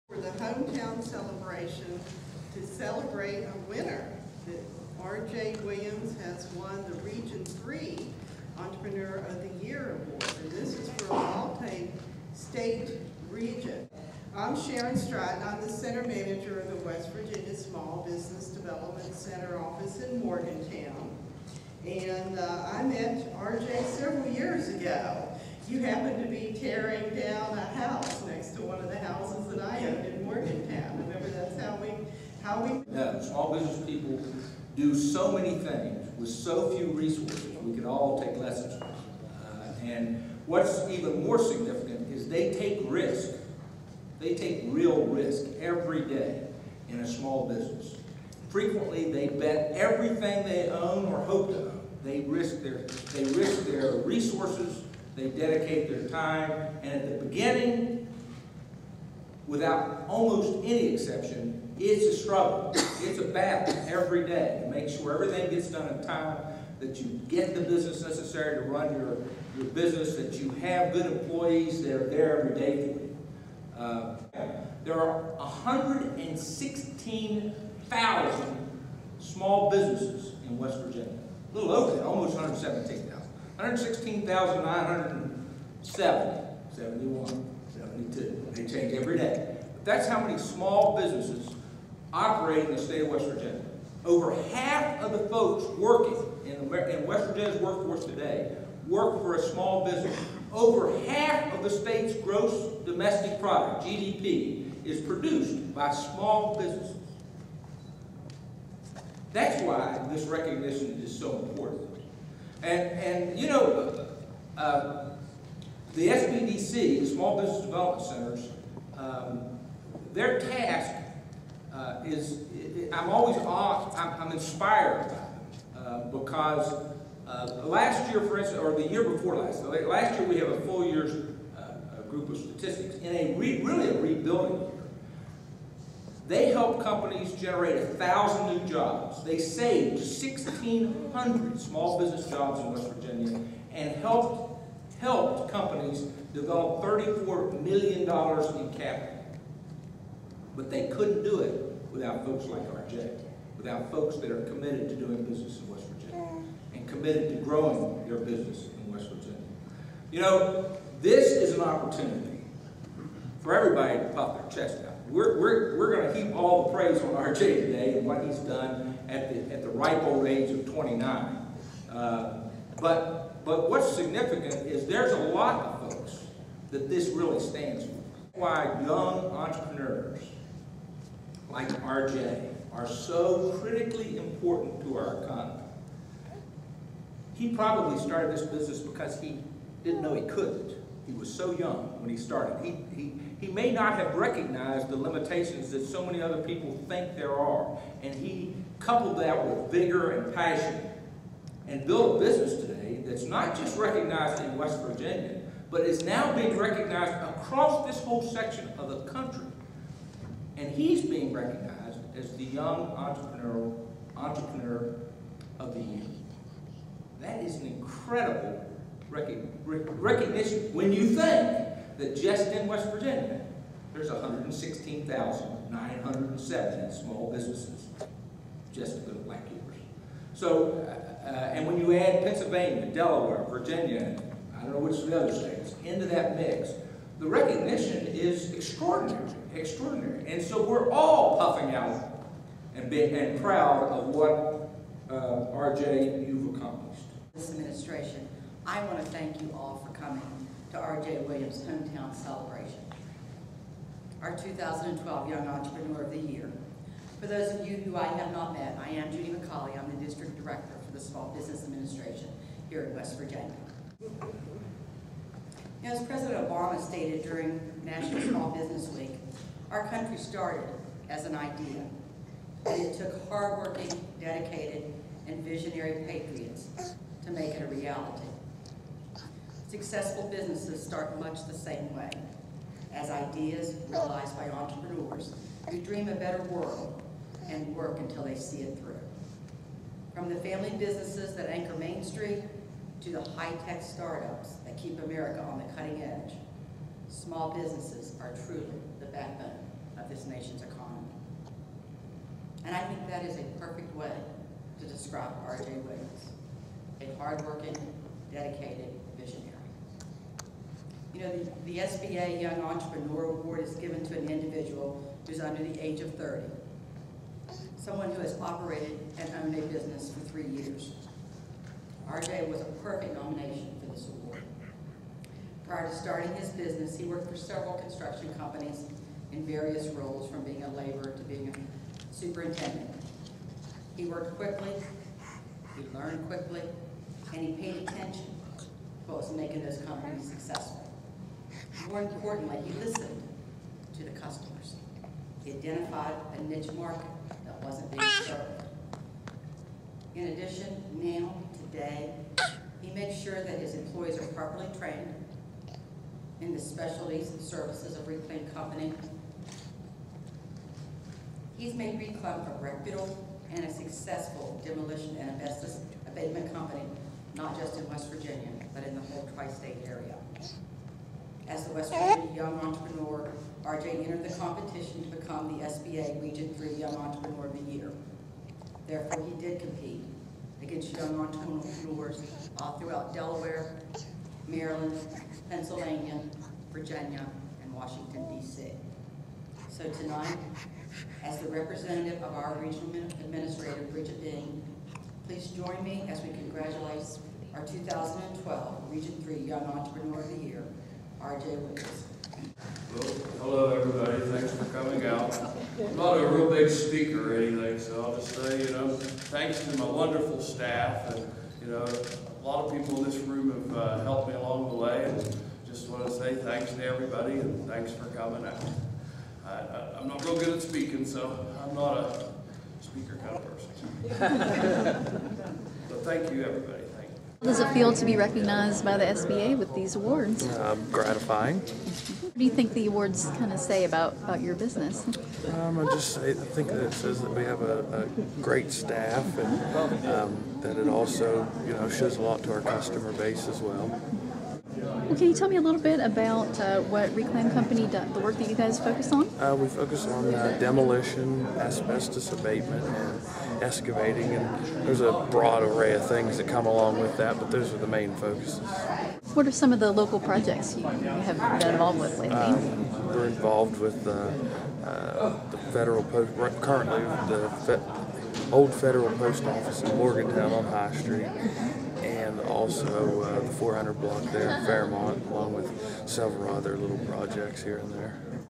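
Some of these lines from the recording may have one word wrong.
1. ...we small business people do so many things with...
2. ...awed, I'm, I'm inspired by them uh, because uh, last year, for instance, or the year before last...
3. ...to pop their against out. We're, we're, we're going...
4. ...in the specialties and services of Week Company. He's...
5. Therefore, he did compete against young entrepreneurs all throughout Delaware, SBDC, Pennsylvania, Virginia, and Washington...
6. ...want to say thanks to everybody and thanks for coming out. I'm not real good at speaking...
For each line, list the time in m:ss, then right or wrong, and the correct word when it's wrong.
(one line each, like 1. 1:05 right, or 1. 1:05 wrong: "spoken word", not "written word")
1. 0:32 right
2. 2:03 right
3. 2:43 wrong: "chest", not "against"
4. 5:56 wrong: "Reclaim", not "Week"
5. 6:18 wrong: "Maryland", not "SBDC"
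6. 6:55 right.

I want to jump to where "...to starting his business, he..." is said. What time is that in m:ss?
5:25.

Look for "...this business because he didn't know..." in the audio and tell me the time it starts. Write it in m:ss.
3:08.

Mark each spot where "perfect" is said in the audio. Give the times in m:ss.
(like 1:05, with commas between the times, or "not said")
5:03, 5:22.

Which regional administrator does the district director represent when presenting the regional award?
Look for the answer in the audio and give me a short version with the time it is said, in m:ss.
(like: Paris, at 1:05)
Bridget Dean, at 6:33.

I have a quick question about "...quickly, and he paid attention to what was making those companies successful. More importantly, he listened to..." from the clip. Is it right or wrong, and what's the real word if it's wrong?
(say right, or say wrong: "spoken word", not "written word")
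right.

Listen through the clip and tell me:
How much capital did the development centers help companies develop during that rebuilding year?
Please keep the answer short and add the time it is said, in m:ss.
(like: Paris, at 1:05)
$34 million, at 2:26.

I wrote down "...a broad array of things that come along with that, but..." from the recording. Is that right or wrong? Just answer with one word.
right.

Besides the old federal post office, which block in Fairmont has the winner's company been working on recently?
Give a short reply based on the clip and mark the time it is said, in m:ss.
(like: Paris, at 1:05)
400 block, at 7:53.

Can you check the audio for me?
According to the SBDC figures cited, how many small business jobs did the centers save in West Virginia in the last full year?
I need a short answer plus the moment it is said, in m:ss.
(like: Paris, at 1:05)
1,600, at 2:19.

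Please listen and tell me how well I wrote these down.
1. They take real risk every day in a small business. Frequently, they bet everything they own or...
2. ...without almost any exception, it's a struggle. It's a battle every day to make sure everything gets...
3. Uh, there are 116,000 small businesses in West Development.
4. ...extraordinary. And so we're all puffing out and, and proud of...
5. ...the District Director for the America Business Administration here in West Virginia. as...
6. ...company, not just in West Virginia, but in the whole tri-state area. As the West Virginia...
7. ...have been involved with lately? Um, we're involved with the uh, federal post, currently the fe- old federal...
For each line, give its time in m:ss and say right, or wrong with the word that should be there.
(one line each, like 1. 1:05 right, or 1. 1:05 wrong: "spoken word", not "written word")
1. 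0:44 right
2. 0:59 right
3. 1:13 wrong: "Virginia", not "Development"
4. 3:59 right
5. 4:19 wrong: "Small", not "America"
6. 6:06 right
7. 7:40 right.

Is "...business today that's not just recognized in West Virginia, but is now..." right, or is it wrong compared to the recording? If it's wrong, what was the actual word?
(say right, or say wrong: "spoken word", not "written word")
right.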